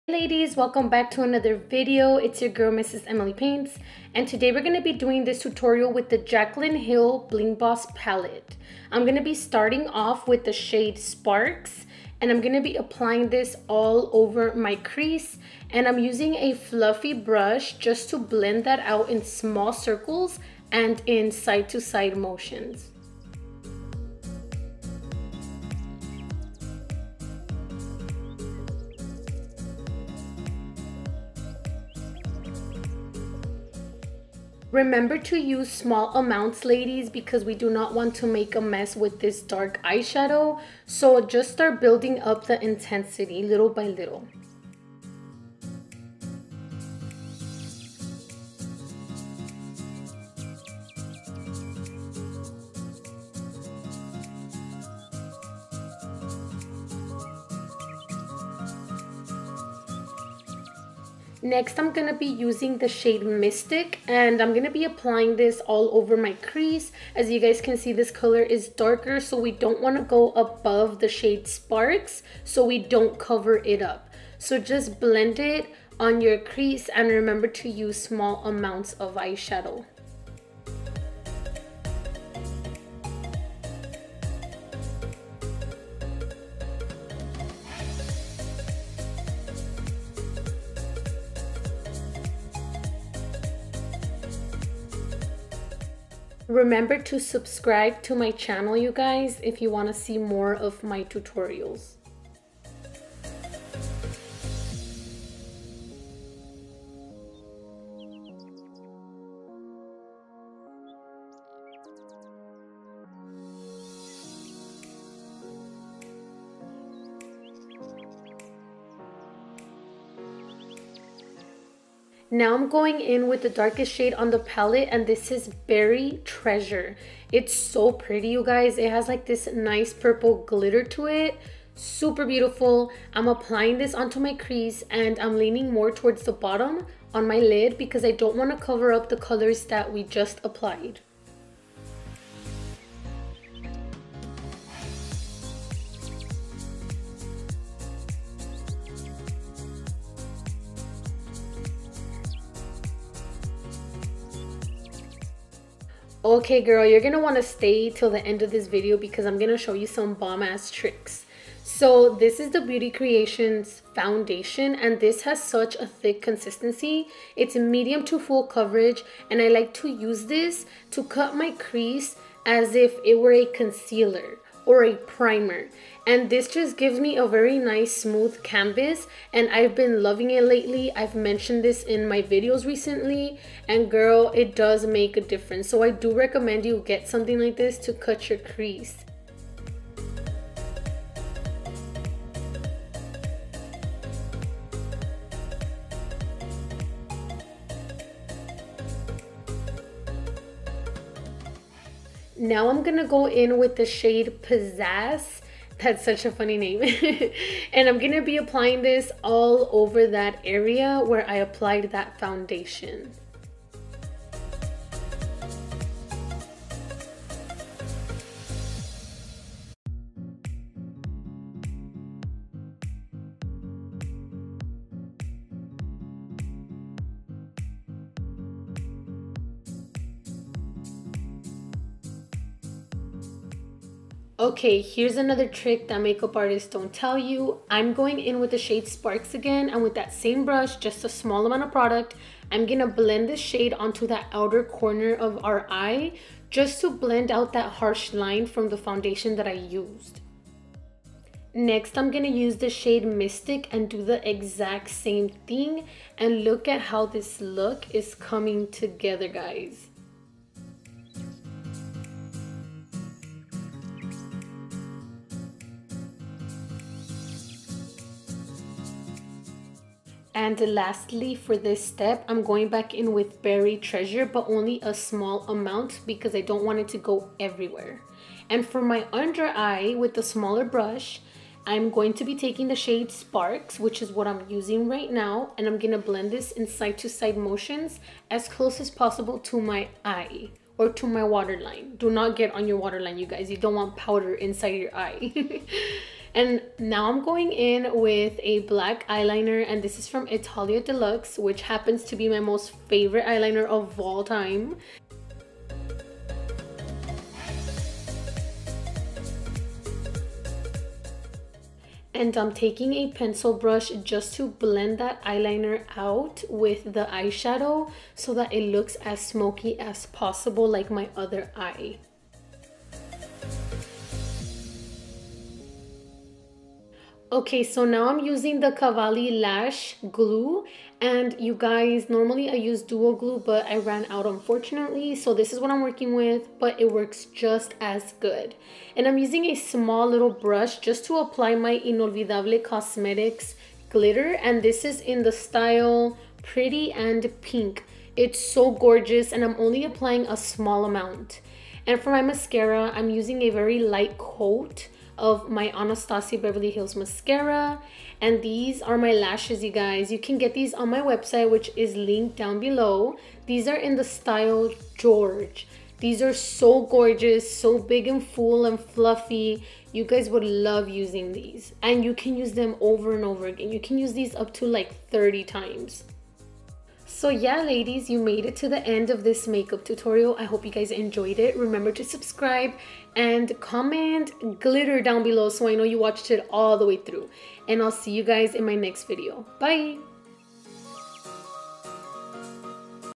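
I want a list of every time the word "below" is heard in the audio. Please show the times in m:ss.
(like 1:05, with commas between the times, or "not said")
6:02, 6:25.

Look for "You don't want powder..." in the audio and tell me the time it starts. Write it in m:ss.
4:53.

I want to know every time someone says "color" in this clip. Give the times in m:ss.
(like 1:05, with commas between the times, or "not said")
1:08, 2:19.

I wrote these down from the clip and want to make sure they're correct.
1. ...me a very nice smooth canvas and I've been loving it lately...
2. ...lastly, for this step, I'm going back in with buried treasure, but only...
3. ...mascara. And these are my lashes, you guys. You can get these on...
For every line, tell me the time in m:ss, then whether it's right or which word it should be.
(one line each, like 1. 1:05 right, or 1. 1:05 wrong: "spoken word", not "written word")
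1. 2:56 right
2. 4:30 right
3. 5:56 right.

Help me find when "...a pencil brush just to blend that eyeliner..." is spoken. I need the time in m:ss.
5:12.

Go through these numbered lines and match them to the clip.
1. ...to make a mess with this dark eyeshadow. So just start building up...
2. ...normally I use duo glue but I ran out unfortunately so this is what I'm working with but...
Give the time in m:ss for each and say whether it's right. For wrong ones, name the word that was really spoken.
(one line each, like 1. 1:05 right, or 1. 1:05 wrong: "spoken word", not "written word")
1. 0:38 right
2. 5:32 right.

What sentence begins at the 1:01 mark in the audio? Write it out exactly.
Next, I'm going to be using the shade Mystic and I'm going to be applying this all over my crease.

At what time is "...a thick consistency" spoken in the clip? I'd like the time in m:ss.
2:45.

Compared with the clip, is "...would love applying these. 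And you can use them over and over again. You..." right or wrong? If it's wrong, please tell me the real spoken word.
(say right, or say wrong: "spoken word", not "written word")
wrong: "using", not "applying".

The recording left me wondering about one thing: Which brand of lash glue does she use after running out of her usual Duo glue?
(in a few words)
Cavalli.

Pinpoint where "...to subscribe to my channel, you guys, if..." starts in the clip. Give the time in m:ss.
1:37.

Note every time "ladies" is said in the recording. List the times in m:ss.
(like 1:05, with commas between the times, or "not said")
0:00, 0:36, 6:17.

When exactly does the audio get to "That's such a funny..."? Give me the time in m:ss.
3:25.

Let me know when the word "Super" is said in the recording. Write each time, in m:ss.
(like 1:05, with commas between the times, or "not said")
2:11.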